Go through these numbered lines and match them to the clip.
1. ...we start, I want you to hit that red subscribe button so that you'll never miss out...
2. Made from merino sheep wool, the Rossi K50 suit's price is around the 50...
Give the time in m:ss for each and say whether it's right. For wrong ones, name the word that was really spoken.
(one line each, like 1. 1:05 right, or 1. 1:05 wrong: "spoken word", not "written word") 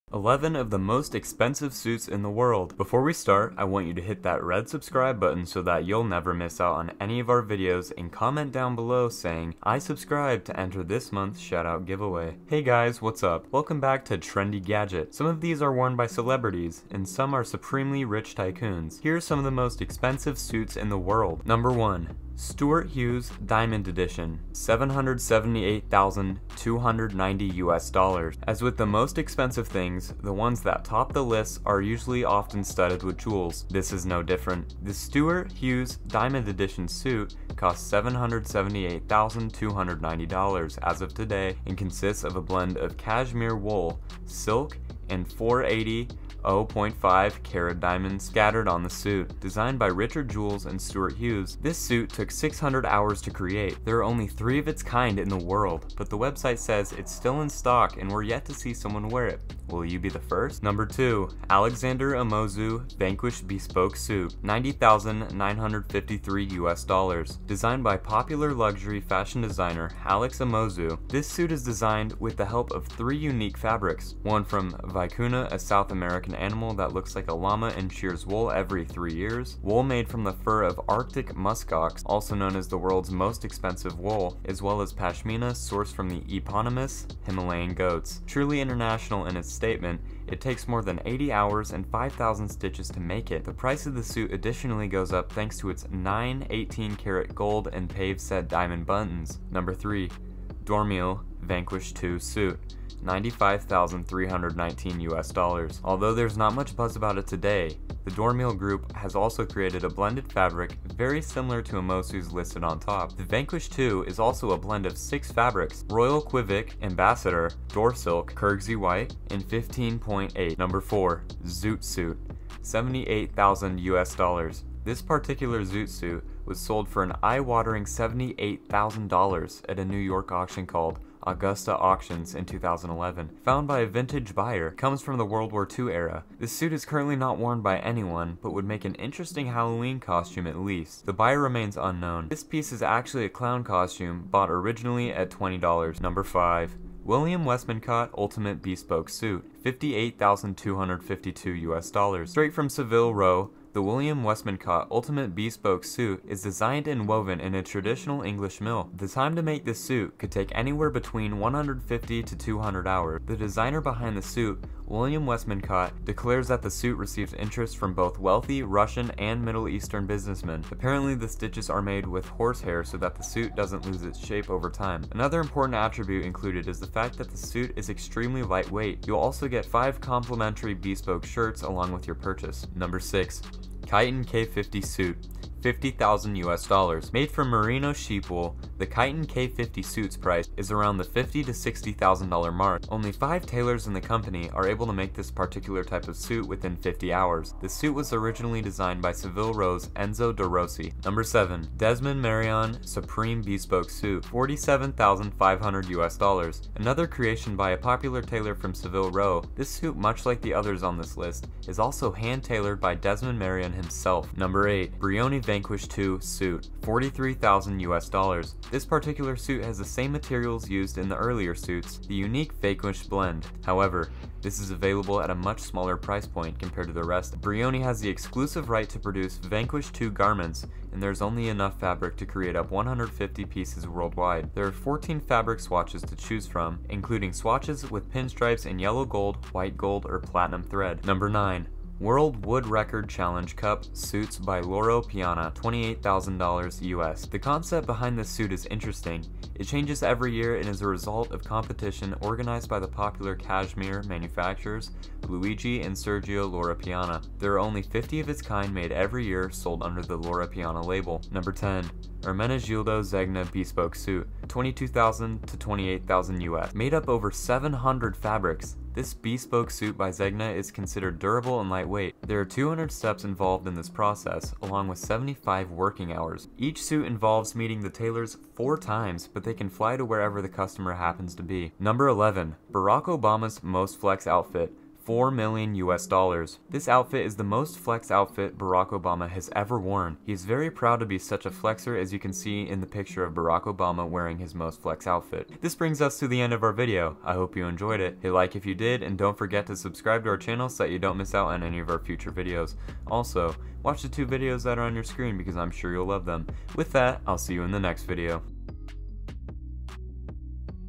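1. 0:03 right
2. 3:07 wrong: "Kiton", not "Rossi".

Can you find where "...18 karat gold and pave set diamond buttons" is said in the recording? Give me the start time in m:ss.
1:36.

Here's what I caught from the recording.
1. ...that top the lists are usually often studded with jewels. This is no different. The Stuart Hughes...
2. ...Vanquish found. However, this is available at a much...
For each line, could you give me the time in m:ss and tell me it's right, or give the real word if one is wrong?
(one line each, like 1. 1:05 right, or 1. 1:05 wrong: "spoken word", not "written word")
1. 0:30 right
2. 3:42 wrong: "blend", not "found".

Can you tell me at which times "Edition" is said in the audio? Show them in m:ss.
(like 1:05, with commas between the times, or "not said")
0:23, 0:36.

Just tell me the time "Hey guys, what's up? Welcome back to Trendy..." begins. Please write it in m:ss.
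0:12.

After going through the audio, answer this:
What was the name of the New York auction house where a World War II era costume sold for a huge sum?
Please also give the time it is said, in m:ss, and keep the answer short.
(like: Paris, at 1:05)
Augusta Auctions, at 2:11.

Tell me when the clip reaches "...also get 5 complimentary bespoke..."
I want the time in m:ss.
2:59.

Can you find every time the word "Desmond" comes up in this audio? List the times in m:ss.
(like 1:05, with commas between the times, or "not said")
3:21, 3:32.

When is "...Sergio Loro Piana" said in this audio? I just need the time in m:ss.
4:15.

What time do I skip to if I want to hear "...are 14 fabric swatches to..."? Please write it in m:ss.
3:54.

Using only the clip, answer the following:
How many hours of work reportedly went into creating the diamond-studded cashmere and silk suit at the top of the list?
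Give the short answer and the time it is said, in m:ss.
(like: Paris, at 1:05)
600, at 0:52.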